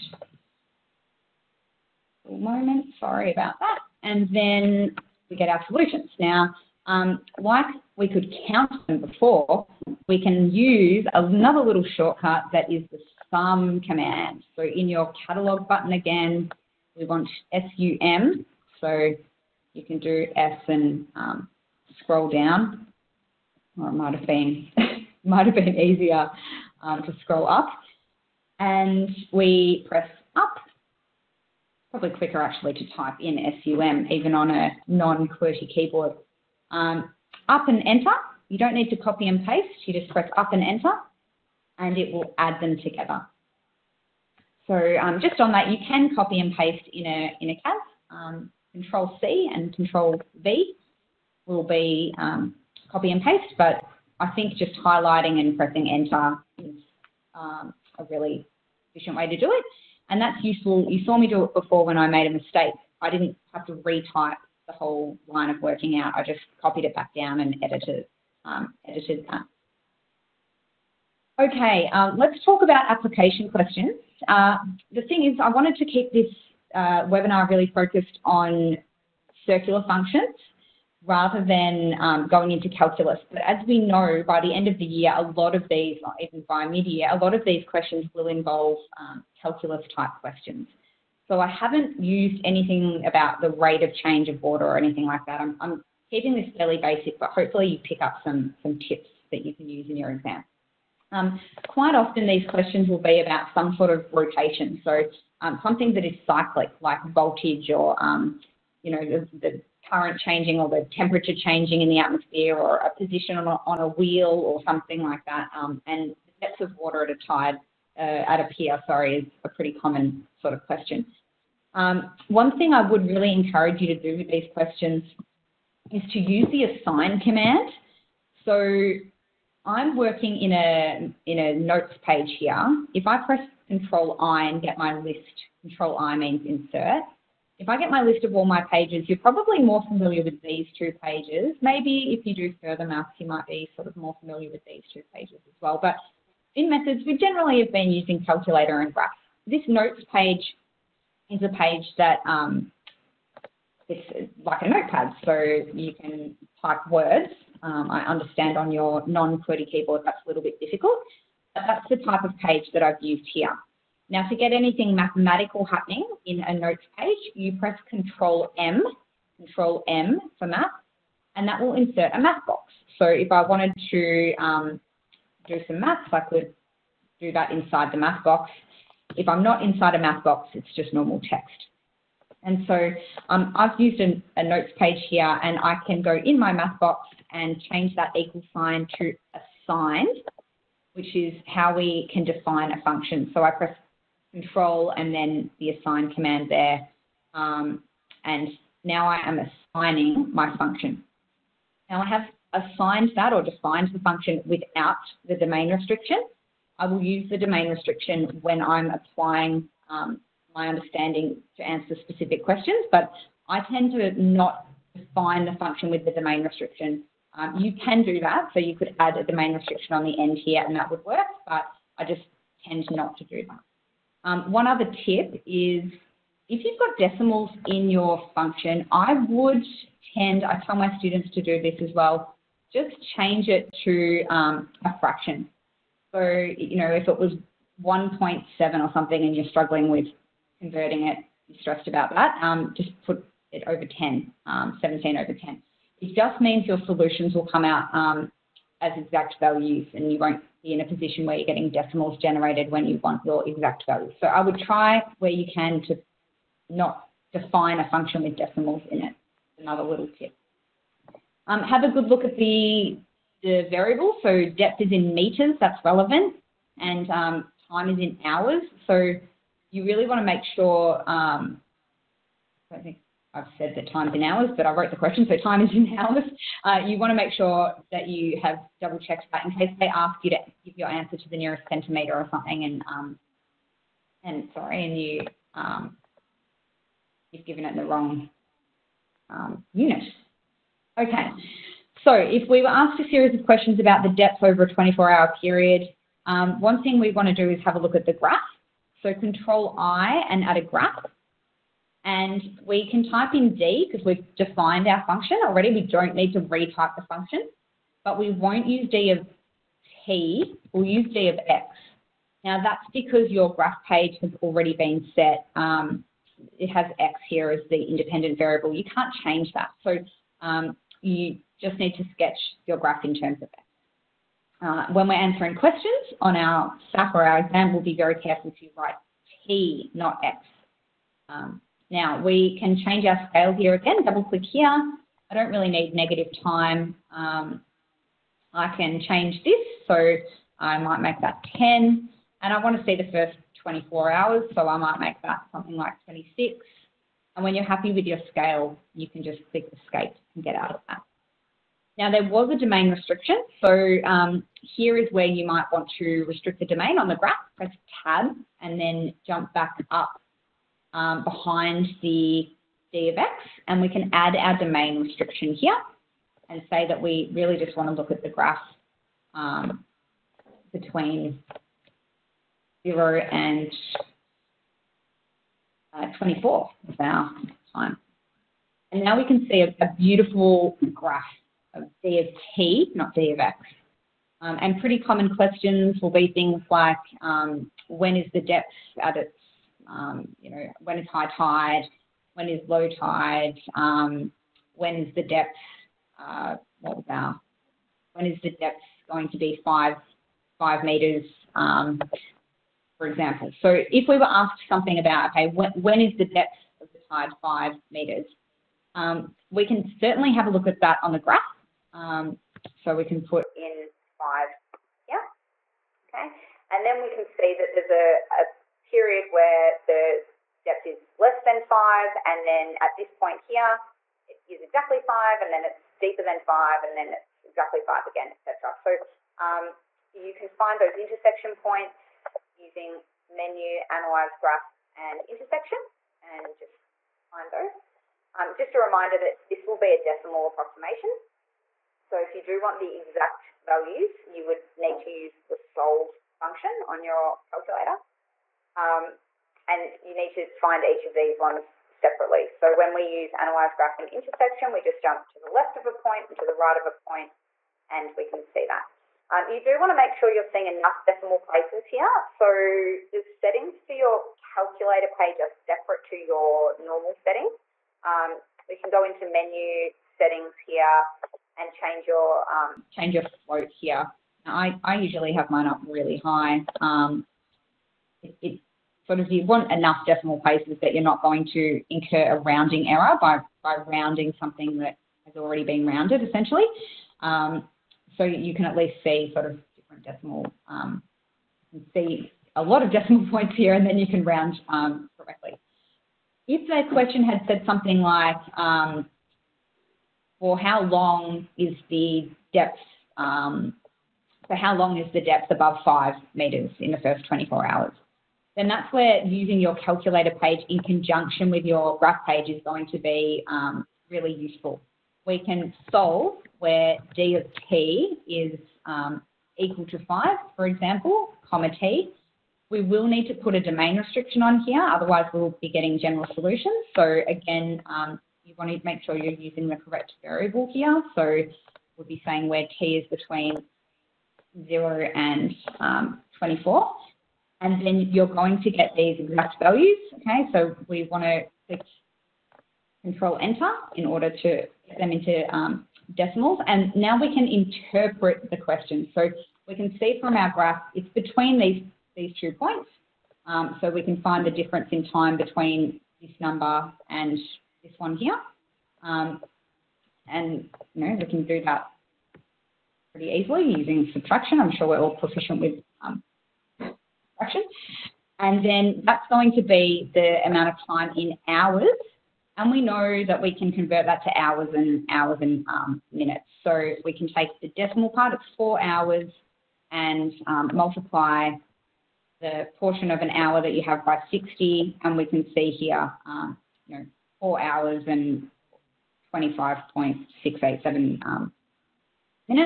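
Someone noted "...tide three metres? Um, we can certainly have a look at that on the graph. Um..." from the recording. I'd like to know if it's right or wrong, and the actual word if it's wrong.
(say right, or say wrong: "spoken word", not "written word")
wrong: "five", not "three".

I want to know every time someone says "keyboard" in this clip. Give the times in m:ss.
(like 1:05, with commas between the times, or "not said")
0:35, 2:39.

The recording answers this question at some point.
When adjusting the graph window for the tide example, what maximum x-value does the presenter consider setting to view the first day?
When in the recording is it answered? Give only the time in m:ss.
5:46.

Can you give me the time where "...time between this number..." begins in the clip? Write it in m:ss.
9:15.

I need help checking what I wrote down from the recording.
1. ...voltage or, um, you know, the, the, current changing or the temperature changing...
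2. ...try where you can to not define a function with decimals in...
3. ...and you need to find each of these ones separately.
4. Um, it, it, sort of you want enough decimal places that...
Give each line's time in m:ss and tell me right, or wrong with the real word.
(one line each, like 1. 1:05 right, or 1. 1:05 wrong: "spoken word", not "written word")
1. 1:47 right
2. 4:14 right
3. 7:29 right
4. 7:56 right.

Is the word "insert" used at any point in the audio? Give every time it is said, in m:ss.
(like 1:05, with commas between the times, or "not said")
2:16, 2:51.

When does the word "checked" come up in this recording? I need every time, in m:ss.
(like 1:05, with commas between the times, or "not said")
4:38.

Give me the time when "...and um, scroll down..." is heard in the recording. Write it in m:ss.
0:20.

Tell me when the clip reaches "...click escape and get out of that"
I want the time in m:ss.
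5:49.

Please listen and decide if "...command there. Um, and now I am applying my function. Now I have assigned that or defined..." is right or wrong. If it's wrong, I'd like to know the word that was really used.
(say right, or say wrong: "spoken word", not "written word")
wrong: "assigning", not "applying".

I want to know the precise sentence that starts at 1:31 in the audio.
So I haven't used anything about the rate of change of water or anything like that.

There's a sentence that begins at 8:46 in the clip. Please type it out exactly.
So again, um, you want to make sure you're using the correct variable here.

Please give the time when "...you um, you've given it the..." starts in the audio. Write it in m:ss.
4:45.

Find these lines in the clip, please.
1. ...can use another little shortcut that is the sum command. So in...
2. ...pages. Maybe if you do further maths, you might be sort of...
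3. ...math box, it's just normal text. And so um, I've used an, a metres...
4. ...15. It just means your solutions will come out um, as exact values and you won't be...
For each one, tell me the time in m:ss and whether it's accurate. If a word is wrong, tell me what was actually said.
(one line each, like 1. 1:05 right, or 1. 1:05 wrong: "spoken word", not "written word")
1. 0:10 right
2. 2:21 right
3. 2:59 wrong: "notes", not "metres"
4. 4:05 wrong: "10", not "15".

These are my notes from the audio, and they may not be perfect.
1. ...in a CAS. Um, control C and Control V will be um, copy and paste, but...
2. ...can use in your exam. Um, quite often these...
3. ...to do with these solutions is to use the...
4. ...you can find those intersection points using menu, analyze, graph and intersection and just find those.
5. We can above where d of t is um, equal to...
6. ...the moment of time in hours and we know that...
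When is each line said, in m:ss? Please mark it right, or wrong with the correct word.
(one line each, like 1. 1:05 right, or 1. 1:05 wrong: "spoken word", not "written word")
1. 0:47 right
2. 1:39 right
3. 2:03 wrong: "questions", not "solutions"
4. 7:10 right
5. 8:35 wrong: "solve", not "above"
6. 9:30 wrong: "amount", not "moment".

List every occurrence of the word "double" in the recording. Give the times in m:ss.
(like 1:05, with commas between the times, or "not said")
4:38, 5:34.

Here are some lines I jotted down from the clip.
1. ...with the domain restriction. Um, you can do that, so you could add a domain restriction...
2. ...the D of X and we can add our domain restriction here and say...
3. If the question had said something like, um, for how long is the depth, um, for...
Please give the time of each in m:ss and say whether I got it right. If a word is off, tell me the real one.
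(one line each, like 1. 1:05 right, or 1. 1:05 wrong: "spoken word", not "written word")
1. 3:35 right
2. 6:02 right
3. 8:16 right.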